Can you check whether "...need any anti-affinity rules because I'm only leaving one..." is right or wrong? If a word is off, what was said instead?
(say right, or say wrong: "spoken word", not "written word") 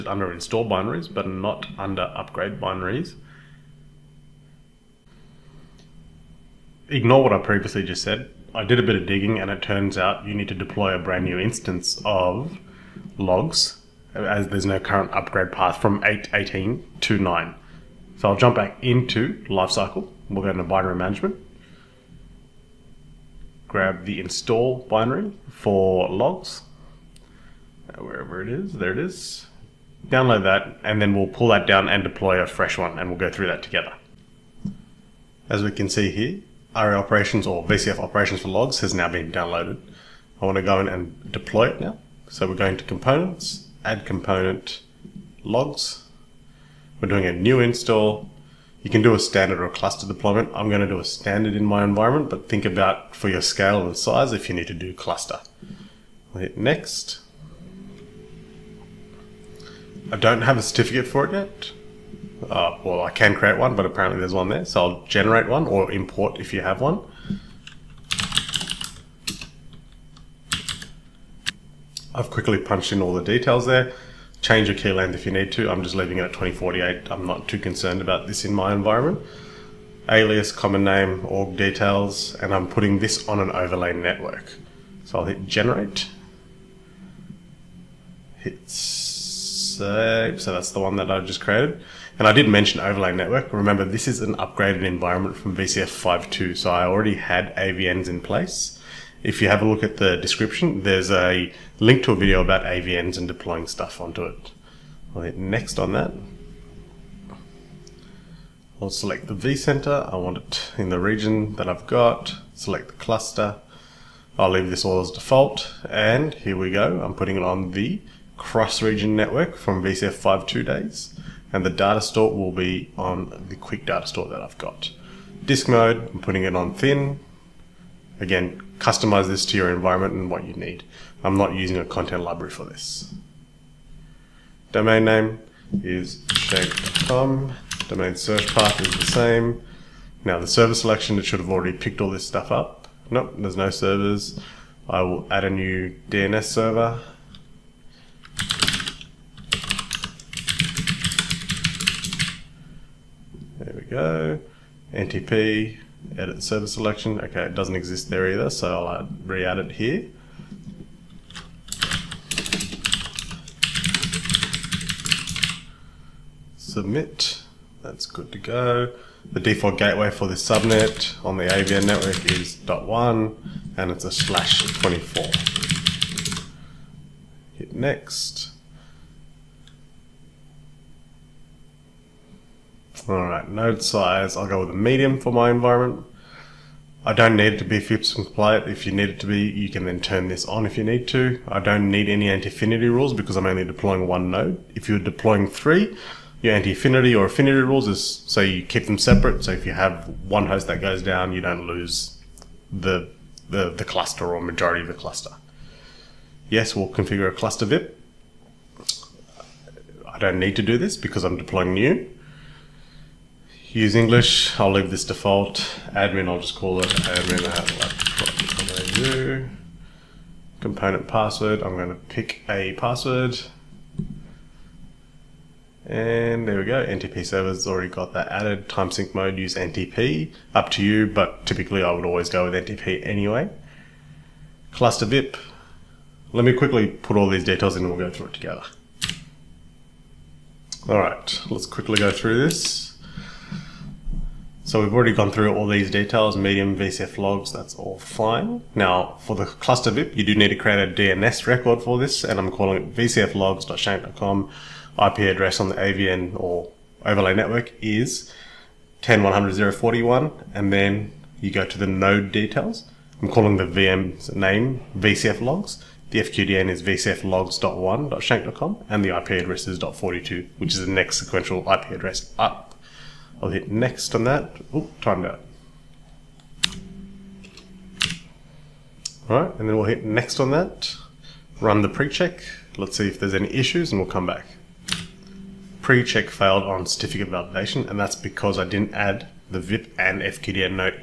wrong: "deploying", not "leaving".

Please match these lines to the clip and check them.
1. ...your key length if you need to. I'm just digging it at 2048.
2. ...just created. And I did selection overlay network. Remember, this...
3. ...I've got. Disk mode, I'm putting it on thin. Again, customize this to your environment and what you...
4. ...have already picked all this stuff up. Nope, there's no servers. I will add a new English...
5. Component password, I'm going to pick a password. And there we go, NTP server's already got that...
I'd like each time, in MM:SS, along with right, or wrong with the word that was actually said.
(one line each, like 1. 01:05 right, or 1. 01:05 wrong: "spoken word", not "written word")
1. 01:14 wrong: "leaving", not "digging"
2. 01:31 wrong: "mention", not "selection"
3. 02:04 right
4. 02:21 wrong: "DNS", not "English"
5. 03:40 right.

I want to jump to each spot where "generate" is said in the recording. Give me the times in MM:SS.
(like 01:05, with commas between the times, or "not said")
01:05, 01:25.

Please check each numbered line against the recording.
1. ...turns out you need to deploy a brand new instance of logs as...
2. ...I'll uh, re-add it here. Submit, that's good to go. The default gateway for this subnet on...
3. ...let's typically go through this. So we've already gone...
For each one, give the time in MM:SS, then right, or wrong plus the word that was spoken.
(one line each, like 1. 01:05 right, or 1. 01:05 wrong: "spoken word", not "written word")
1. 00:09 right
2. 02:38 right
3. 04:01 wrong: "quickly", not "typically".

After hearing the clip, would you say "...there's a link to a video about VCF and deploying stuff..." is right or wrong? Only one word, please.
wrong.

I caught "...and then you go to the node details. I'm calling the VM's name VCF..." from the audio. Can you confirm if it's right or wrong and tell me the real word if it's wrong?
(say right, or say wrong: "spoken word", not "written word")
right.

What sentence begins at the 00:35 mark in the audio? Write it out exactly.
As we can see here, Aria operations or VCF operations for logs has now been downloaded.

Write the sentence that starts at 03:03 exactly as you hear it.
Alright, node size, I'll go with a medium for my environment.